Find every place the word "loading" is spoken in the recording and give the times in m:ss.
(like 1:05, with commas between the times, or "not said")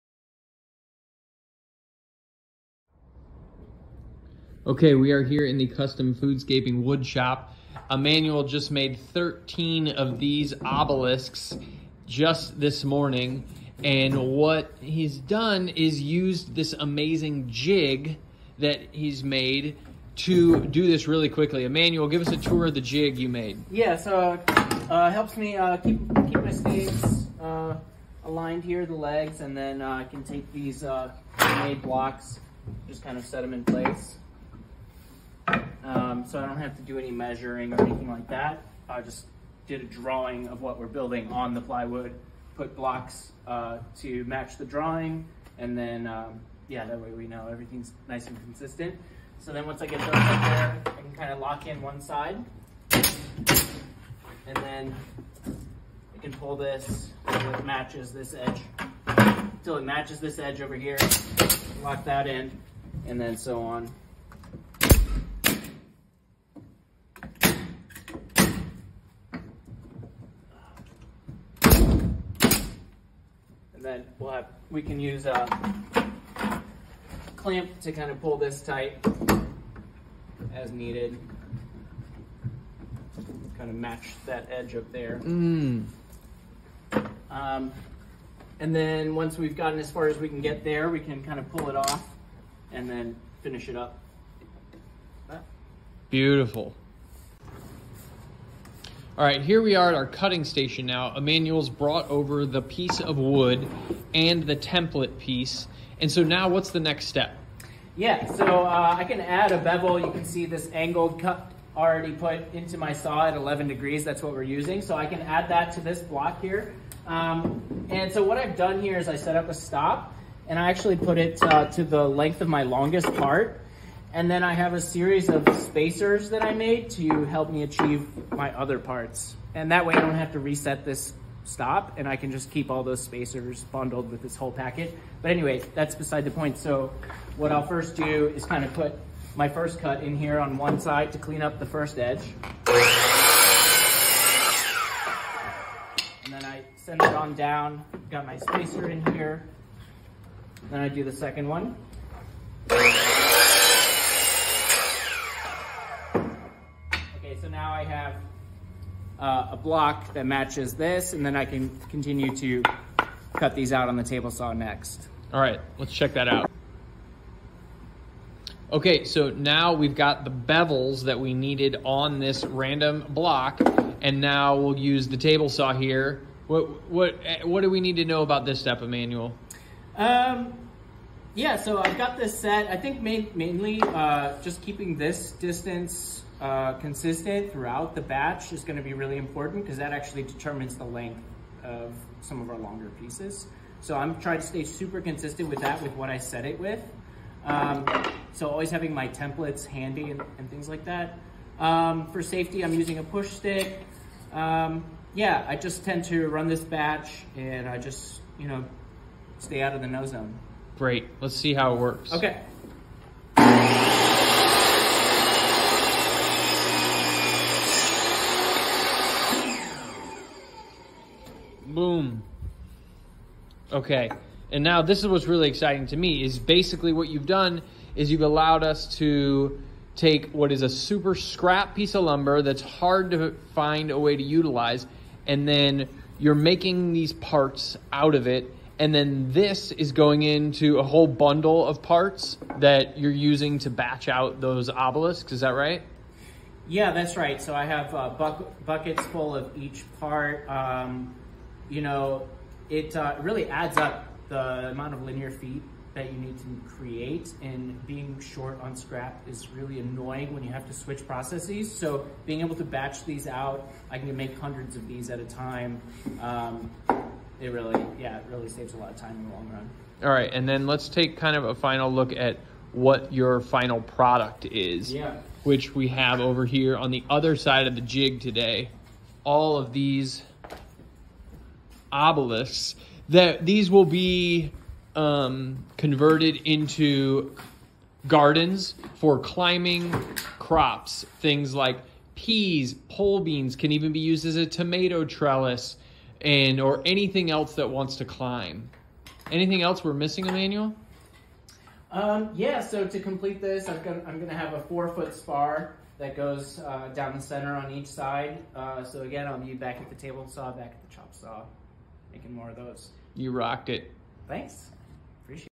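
not said.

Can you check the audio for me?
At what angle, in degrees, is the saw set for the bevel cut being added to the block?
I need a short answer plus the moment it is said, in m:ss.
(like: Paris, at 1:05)
11, at 1:53.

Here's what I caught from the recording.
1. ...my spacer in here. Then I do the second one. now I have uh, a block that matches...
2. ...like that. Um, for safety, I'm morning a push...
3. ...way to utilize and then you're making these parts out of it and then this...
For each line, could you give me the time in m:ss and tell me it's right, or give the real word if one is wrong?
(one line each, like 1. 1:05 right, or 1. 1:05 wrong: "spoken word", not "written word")
1. 2:28 right
2. 3:20 wrong: "using", not "morning"
3. 3:53 right.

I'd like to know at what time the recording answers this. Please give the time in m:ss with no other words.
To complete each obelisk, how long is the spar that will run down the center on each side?
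5:04.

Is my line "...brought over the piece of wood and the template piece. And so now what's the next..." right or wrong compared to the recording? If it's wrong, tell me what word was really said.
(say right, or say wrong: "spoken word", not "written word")
right.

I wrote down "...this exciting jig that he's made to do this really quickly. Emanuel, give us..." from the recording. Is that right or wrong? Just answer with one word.
wrong.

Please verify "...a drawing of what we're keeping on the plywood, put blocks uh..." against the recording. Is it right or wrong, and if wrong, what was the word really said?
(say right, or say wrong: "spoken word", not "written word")
wrong: "building", not "keeping".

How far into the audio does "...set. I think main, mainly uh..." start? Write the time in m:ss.
3:02.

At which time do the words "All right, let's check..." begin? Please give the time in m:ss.
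2:45.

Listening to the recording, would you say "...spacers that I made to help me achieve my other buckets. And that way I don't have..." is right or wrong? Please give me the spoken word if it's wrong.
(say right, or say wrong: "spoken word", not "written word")
wrong: "parts", not "buckets".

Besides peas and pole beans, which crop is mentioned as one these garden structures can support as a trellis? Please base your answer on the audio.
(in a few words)
tomato.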